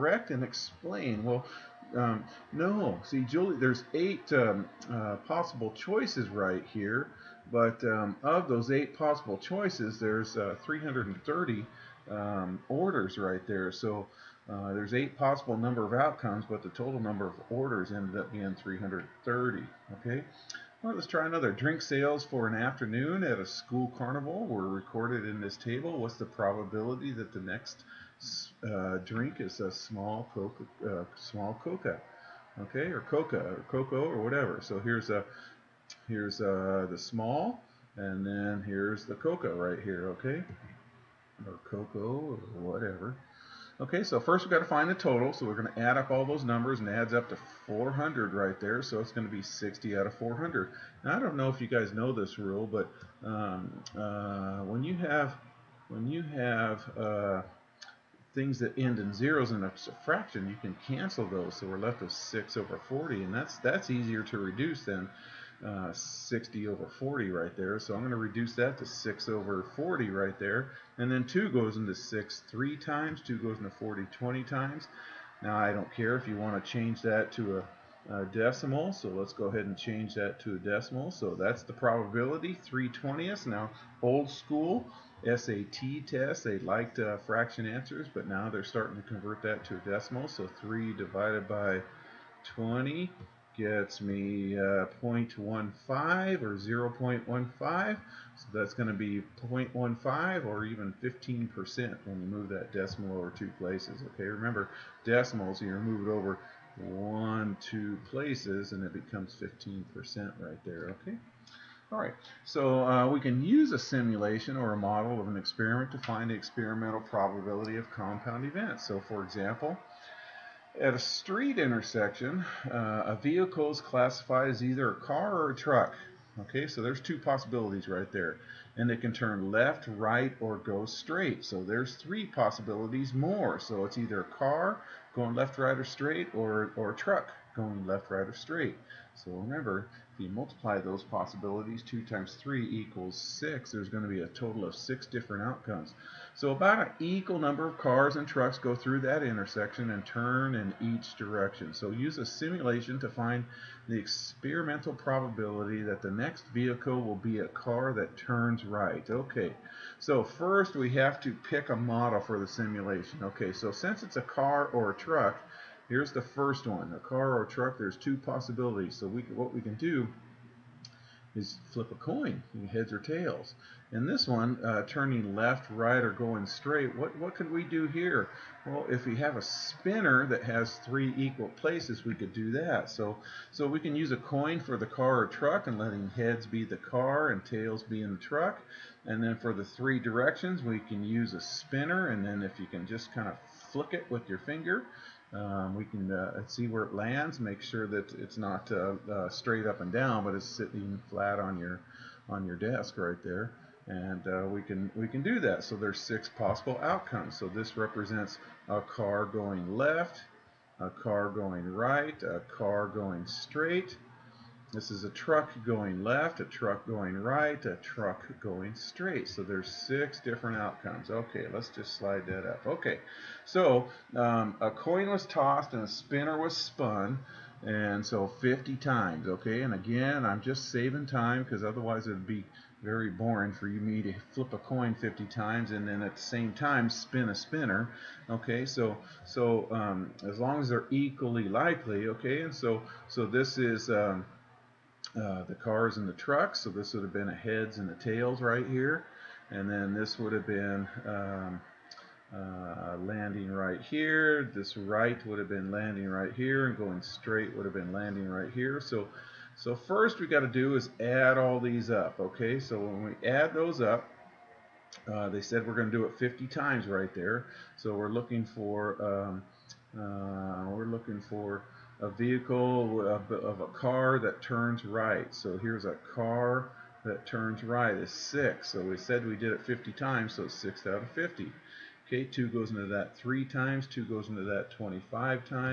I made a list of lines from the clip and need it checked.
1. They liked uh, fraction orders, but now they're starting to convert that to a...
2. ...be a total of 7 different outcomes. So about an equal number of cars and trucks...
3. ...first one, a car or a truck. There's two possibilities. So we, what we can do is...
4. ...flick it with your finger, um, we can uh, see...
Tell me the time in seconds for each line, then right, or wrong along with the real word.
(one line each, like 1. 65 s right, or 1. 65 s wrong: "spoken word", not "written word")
1. 86 s wrong: "answers", not "orders"
2. 144 s wrong: "6", not "7"
3. 166 s right
4. 193 s right.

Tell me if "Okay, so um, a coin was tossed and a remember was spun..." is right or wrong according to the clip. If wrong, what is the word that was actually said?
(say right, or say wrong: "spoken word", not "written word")
wrong: "spinner", not "remember".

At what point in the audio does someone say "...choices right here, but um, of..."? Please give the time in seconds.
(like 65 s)
5 s.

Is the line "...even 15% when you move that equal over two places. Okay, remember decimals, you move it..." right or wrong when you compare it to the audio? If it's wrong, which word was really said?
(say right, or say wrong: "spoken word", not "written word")
wrong: "decimal", not "equal".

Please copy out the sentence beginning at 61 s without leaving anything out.
So we're left with 6 over 40, and that's, that's easier to reduce than uh, 60 over 40 right there.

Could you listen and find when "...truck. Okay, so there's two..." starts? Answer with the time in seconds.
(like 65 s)
125 s.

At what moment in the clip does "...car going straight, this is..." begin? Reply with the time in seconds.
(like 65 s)
212 s.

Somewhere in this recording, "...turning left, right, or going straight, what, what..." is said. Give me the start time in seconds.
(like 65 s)
174 s.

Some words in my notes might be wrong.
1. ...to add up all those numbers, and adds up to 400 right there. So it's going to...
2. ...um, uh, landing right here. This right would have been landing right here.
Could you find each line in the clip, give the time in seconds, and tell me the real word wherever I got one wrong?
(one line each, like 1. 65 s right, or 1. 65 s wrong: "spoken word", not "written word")
1. 45 s right
2. 251 s right.